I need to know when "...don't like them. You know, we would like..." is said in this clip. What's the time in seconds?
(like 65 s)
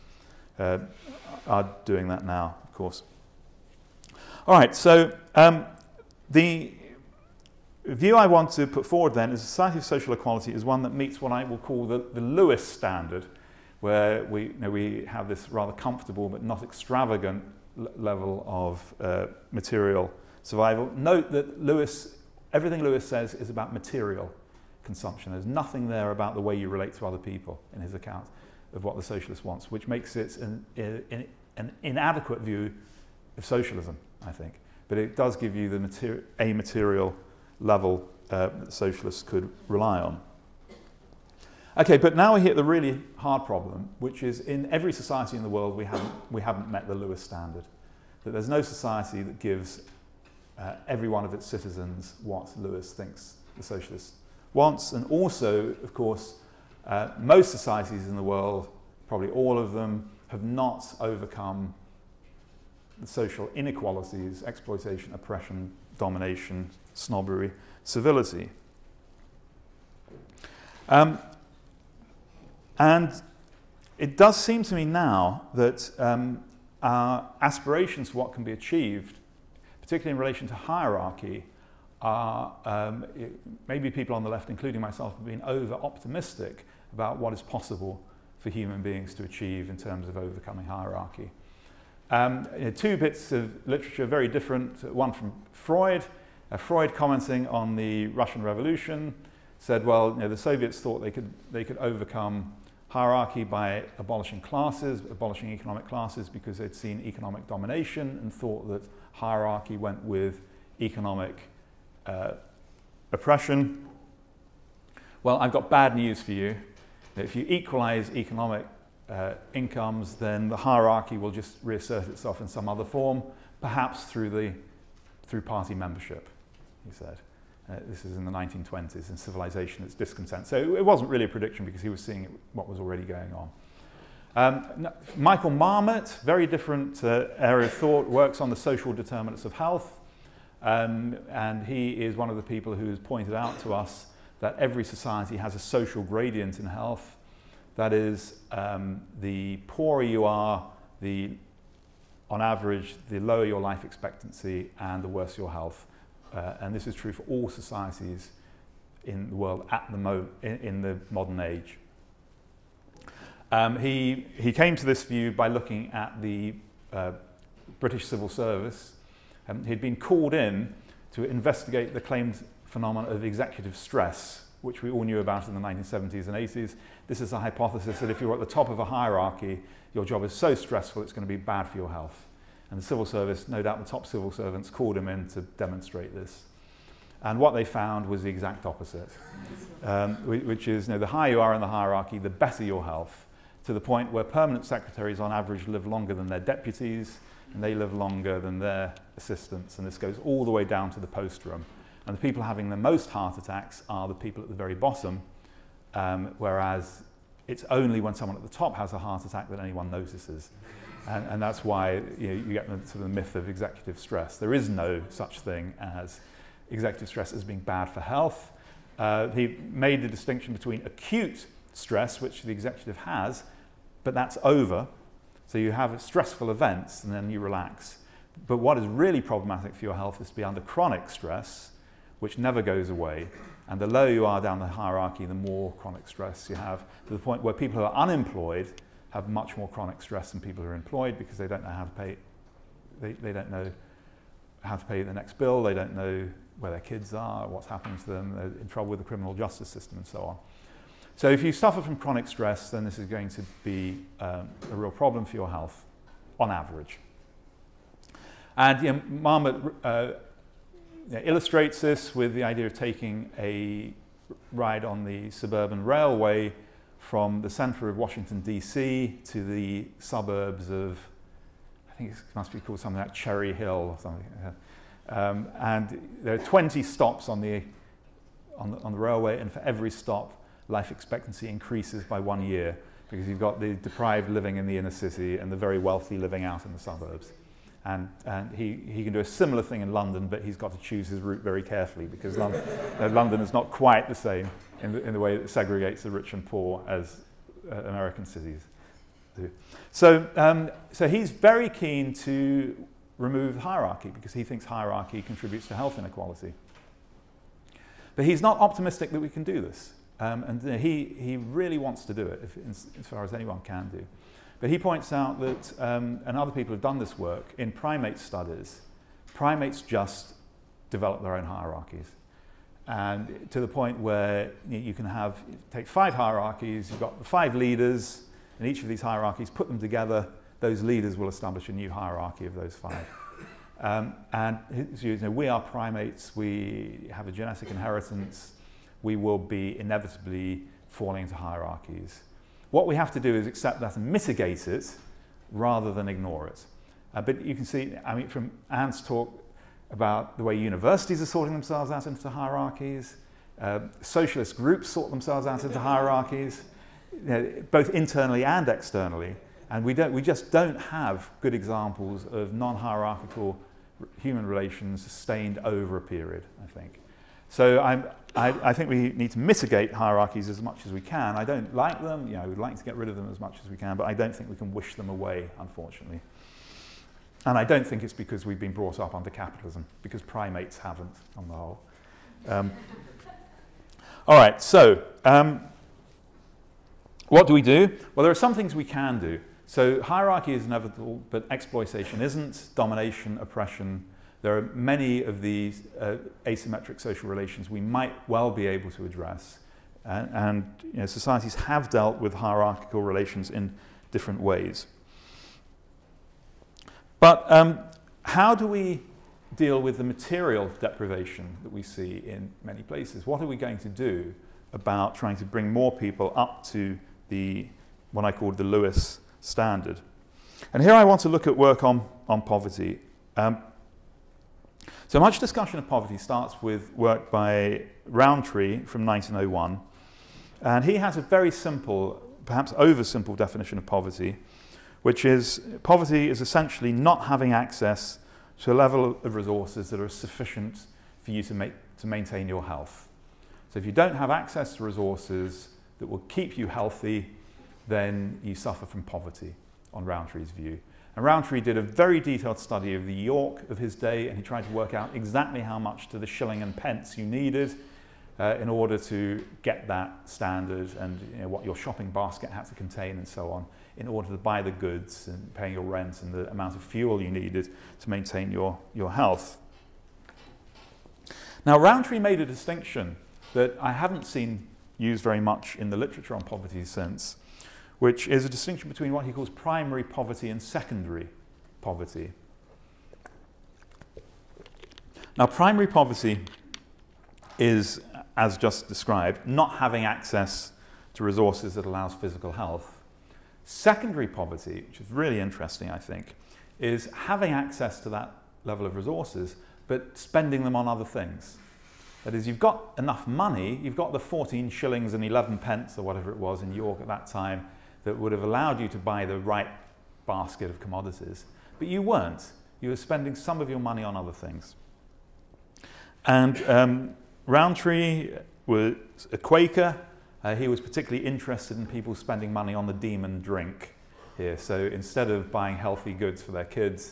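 371 s.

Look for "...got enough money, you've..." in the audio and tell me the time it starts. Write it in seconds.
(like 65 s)
502 s.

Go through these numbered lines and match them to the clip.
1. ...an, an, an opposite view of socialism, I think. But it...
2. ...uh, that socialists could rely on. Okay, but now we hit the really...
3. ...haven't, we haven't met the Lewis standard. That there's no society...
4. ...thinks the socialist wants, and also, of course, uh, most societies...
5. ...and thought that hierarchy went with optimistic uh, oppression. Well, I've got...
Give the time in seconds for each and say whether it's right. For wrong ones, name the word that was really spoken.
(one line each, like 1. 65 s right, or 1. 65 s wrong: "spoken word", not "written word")
1. 30 s wrong: "inadequate", not "opposite"
2. 38 s right
3. 45 s right
4. 52 s right
5. 108 s wrong: "economic", not "optimistic".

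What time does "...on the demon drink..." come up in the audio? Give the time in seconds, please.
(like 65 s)
522 s.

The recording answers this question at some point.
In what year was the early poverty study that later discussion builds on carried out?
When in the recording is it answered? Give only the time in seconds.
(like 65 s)
429 s.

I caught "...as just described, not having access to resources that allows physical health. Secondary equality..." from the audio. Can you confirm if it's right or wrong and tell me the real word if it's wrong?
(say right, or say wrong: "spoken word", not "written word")
wrong: "poverty", not "equality".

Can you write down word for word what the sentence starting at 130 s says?
So it wasn't really a prediction because he was seeing what was already going on.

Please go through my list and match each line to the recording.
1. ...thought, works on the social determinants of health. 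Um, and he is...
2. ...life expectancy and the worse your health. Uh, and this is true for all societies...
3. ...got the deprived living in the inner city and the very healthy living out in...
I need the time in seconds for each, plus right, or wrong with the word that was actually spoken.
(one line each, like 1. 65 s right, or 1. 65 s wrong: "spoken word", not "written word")
1. 137 s right
2. 153 s right
3. 283 s wrong: "wealthy", not "healthy".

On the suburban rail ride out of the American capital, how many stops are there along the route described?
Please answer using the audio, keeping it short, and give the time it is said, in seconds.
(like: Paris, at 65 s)
20, at 276 s.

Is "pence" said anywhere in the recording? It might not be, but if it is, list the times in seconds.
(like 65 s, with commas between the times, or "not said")
456 s, 505 s.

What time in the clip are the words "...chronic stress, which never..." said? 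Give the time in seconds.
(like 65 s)
230 s.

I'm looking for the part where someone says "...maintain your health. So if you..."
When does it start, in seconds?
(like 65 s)
442 s.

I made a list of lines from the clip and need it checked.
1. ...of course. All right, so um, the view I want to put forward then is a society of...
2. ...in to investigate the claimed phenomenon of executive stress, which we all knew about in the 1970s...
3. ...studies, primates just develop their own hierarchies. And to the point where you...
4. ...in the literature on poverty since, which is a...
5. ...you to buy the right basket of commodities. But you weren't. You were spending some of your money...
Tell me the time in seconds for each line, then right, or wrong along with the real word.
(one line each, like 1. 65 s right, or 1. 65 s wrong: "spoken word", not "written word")
1. 2 s right
2. 170 s right
3. 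318 s right
4. 475 s right
5. 508 s right.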